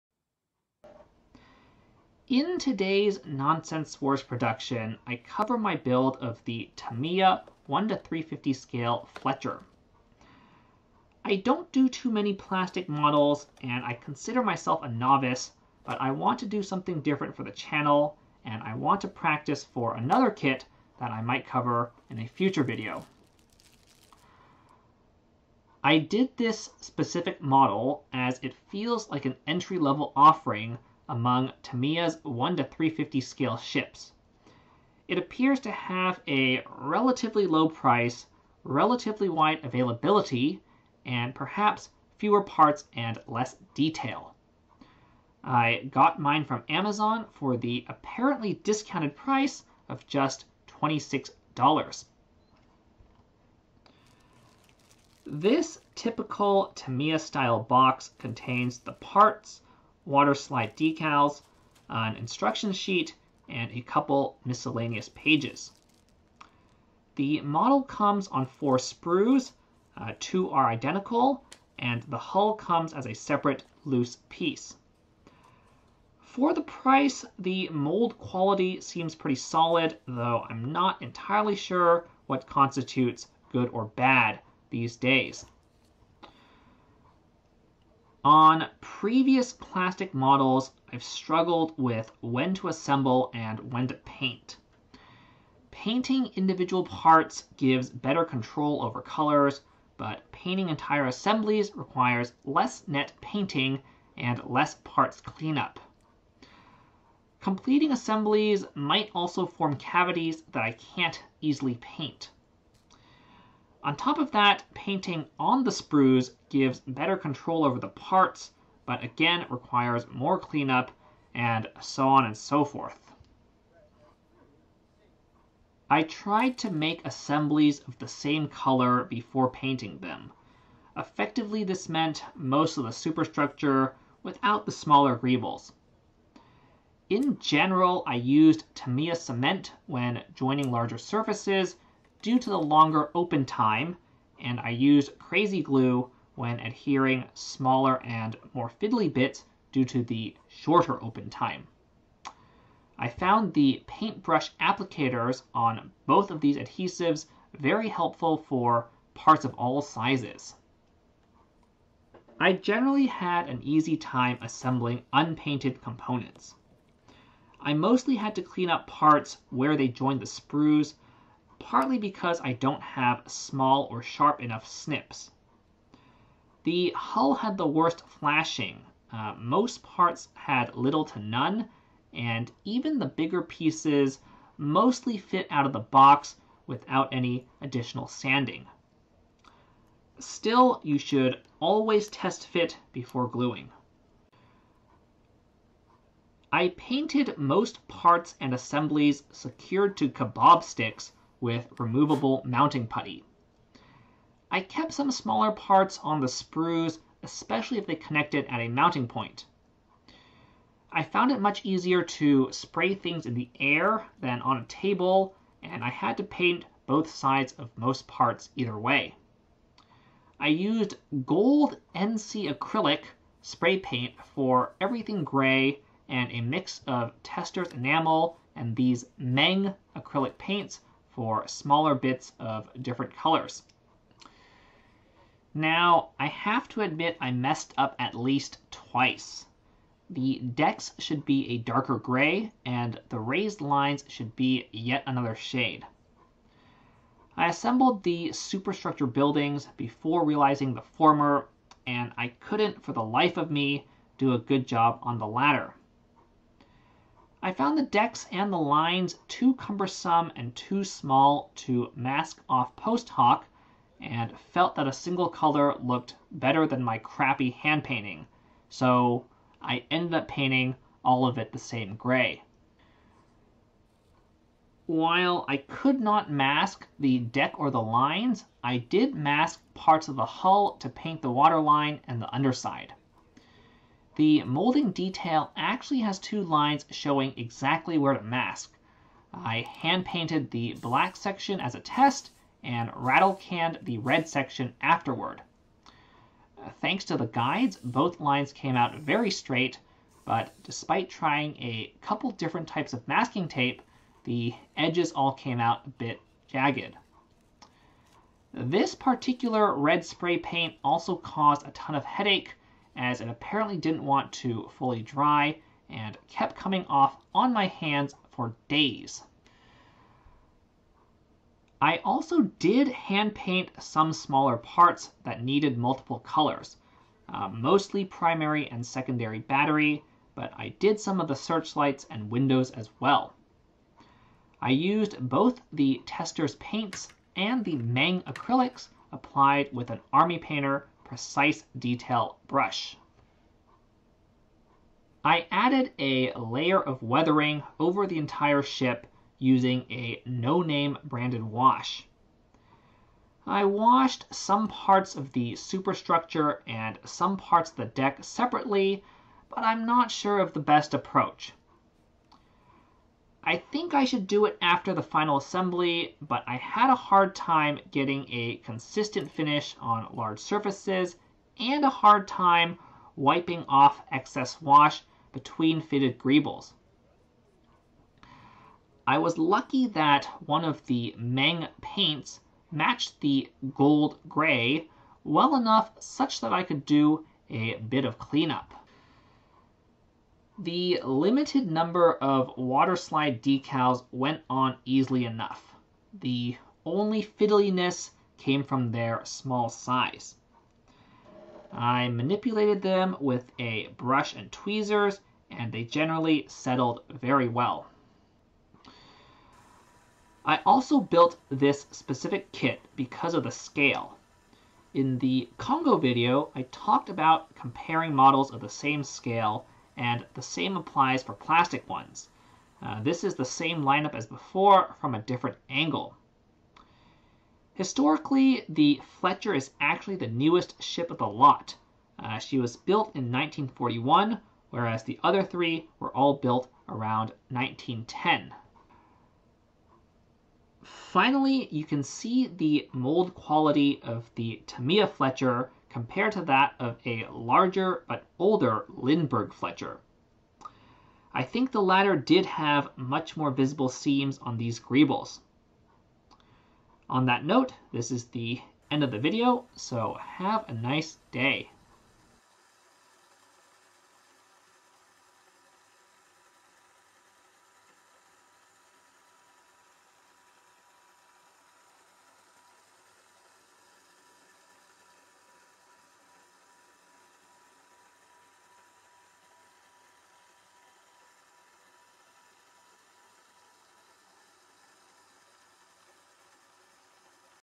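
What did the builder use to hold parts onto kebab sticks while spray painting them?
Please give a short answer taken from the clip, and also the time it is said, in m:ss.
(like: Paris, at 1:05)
removable mounting putty, at 3:21.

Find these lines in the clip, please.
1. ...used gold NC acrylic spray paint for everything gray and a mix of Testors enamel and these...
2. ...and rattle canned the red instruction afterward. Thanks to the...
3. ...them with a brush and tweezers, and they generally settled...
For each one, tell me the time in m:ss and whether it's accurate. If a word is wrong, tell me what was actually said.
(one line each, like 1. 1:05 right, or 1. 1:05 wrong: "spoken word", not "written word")
1. 3:40 right
2. 4:52 wrong: "section", not "instruction"
3. 6:42 right.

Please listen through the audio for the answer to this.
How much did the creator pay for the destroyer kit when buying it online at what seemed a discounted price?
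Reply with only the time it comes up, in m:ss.
0:50.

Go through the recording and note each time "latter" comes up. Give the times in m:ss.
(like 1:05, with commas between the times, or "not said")
4:15, 7:31.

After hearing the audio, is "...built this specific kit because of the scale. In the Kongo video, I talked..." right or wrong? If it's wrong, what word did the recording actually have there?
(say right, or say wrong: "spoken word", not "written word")
right.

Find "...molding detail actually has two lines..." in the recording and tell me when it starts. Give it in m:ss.
4:44.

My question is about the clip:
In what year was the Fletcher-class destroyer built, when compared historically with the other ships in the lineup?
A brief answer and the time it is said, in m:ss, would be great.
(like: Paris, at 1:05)
1941, at 7:13.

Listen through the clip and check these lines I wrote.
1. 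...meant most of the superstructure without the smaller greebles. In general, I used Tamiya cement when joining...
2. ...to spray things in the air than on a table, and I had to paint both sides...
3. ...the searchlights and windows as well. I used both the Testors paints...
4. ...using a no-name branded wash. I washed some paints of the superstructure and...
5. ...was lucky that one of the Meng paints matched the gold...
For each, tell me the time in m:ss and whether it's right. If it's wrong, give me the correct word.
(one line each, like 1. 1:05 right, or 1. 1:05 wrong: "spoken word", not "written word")
1. 2:11 right
2. 3:32 right
3. 5:31 right
4. 5:49 wrong: "parts", not "paints"
5. 6:19 right.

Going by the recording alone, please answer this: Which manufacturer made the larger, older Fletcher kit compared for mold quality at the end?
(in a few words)
Lindbergh.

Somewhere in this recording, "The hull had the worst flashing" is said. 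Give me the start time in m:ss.
2:56.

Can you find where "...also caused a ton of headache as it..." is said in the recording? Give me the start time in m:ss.
5:10.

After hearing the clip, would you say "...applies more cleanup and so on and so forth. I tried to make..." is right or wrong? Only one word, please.
wrong.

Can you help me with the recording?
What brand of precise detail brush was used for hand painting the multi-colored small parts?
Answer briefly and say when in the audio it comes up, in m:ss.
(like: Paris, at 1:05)
Army Painter, at 5:40.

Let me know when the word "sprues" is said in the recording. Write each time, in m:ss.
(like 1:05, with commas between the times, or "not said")
1:08, 1:55, 2:50, 3:26.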